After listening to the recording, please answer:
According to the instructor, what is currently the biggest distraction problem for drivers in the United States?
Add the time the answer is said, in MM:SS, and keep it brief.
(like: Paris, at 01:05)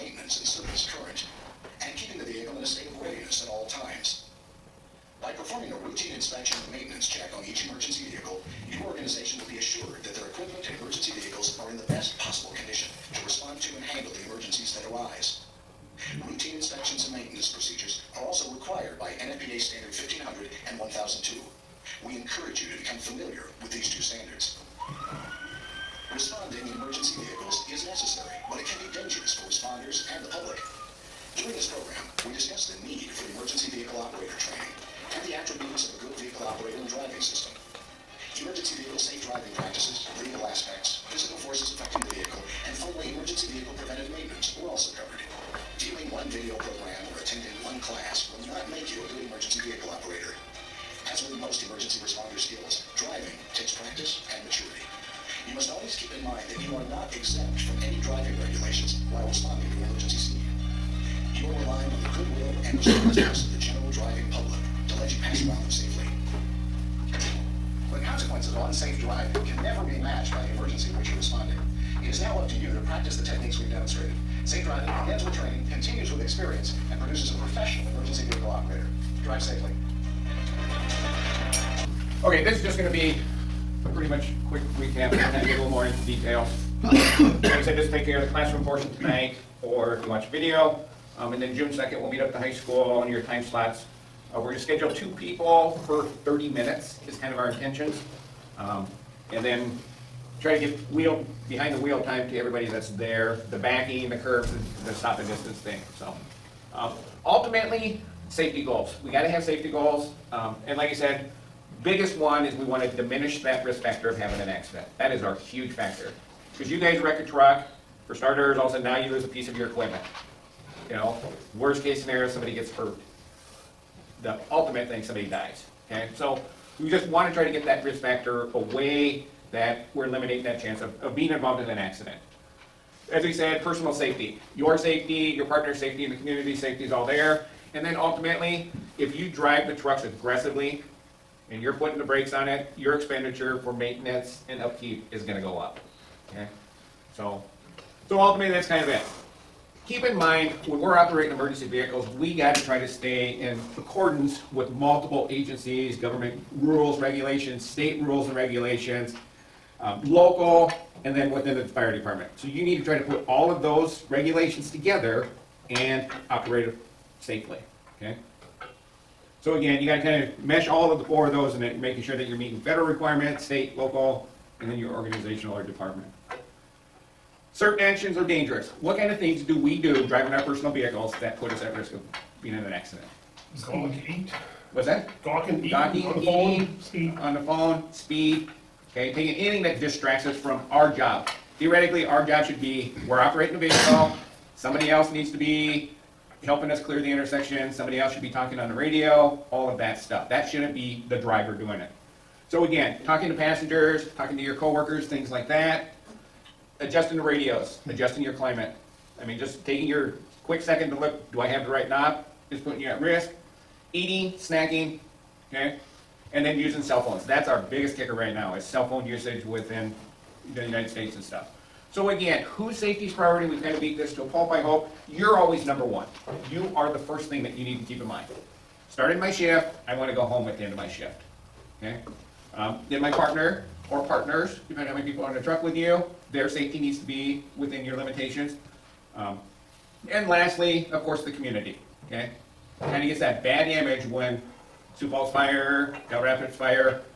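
Cell phone usage, at 03:38.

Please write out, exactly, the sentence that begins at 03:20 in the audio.
That shouldn't be the driver doing it.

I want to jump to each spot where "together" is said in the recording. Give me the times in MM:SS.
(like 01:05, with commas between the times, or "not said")
02:44.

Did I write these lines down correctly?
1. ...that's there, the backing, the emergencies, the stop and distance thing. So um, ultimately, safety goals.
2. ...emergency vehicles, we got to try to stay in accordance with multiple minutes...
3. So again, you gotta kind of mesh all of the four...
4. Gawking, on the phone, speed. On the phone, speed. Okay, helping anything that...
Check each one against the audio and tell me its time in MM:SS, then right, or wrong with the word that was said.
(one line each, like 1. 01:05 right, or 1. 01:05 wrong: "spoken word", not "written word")
1. 01:42 wrong: "curves", not "emergencies"
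2. 02:31 wrong: "agencies", not "minutes"
3. 02:49 right
4. 03:05 wrong: "taking", not "helping".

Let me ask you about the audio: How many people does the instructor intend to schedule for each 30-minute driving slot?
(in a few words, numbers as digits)
2.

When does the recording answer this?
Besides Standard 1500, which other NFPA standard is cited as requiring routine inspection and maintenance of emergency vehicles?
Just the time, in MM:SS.
00:20.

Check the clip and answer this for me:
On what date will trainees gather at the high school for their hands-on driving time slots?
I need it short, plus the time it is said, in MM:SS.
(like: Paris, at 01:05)
June 2nd, at 01:31.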